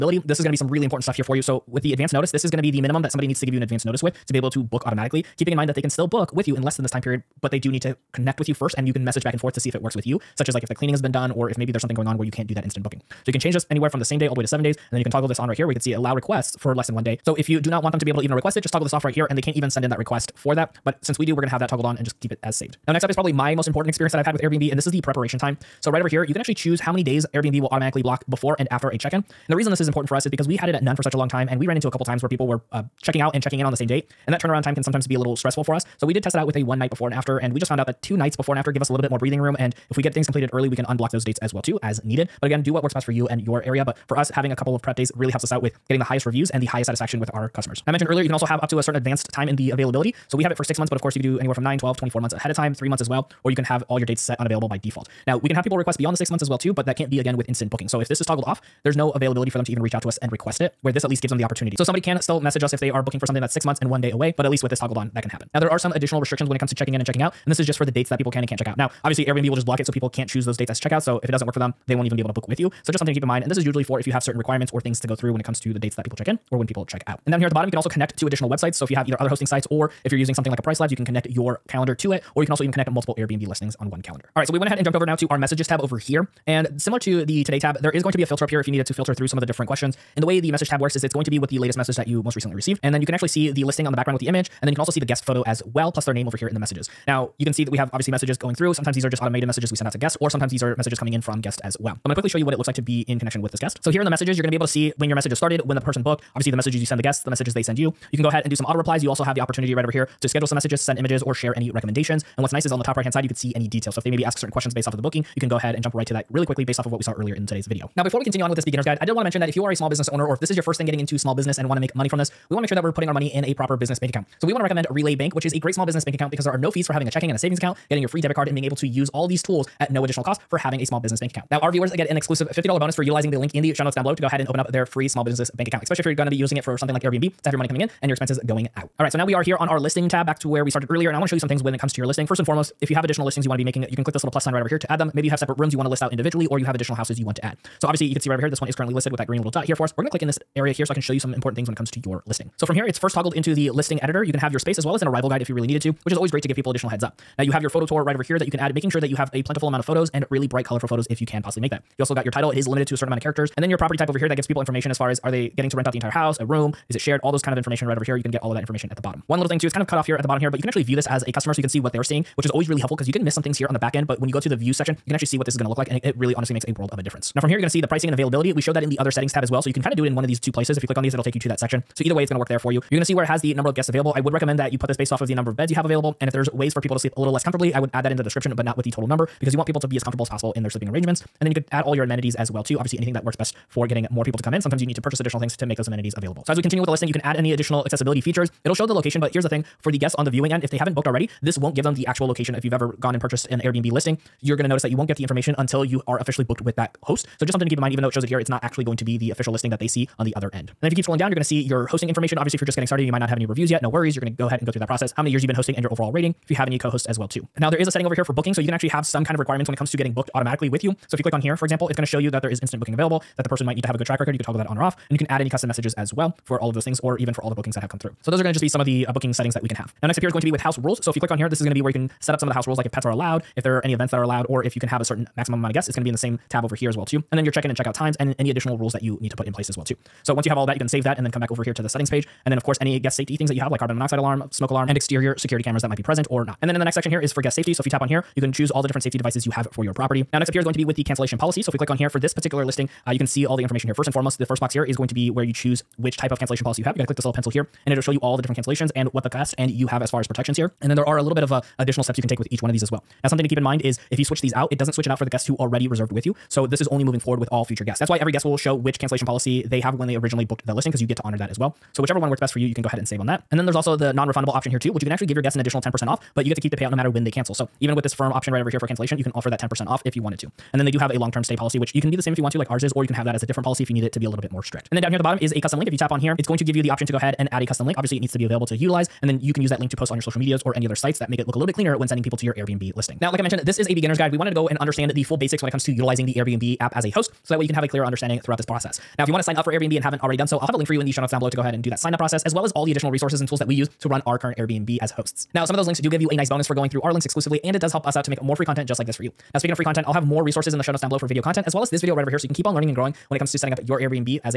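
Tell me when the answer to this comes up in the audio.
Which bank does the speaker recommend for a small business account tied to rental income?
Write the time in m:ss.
2:04.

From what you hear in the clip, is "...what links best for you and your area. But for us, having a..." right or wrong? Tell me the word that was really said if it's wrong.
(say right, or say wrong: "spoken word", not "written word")
wrong: "works", not "links".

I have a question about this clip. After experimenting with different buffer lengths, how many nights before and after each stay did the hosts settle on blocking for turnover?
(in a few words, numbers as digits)
2.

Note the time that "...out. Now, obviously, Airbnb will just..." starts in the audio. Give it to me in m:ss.
1:08.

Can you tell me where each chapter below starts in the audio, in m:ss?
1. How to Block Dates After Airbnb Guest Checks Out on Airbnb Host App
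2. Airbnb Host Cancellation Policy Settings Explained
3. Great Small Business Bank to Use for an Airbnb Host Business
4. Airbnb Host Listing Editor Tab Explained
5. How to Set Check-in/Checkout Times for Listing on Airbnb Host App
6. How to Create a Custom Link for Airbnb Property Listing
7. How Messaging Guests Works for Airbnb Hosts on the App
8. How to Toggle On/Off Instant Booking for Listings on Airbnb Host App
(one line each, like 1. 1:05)
1. 0:22
2. 4:09
3. 1:57
4. 2:19
5. 3:49
6. 4:44
7. 1:23
8. 3:37.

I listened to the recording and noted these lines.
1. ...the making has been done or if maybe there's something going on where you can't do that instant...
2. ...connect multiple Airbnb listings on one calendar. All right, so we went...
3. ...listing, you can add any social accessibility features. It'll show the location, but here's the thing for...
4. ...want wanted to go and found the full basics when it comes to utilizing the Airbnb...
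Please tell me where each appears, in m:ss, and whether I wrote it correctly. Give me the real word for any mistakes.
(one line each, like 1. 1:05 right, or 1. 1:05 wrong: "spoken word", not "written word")
1. 0:10 wrong: "cleaning", not "making"
2. 1:22 right
3. 3:16 wrong: "additional", not "social"
4. 4:54 wrong: "understand", not "found".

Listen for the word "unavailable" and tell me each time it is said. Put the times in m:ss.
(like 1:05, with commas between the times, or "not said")
0:54.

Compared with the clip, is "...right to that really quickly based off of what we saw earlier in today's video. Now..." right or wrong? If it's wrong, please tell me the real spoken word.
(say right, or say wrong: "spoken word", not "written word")
right.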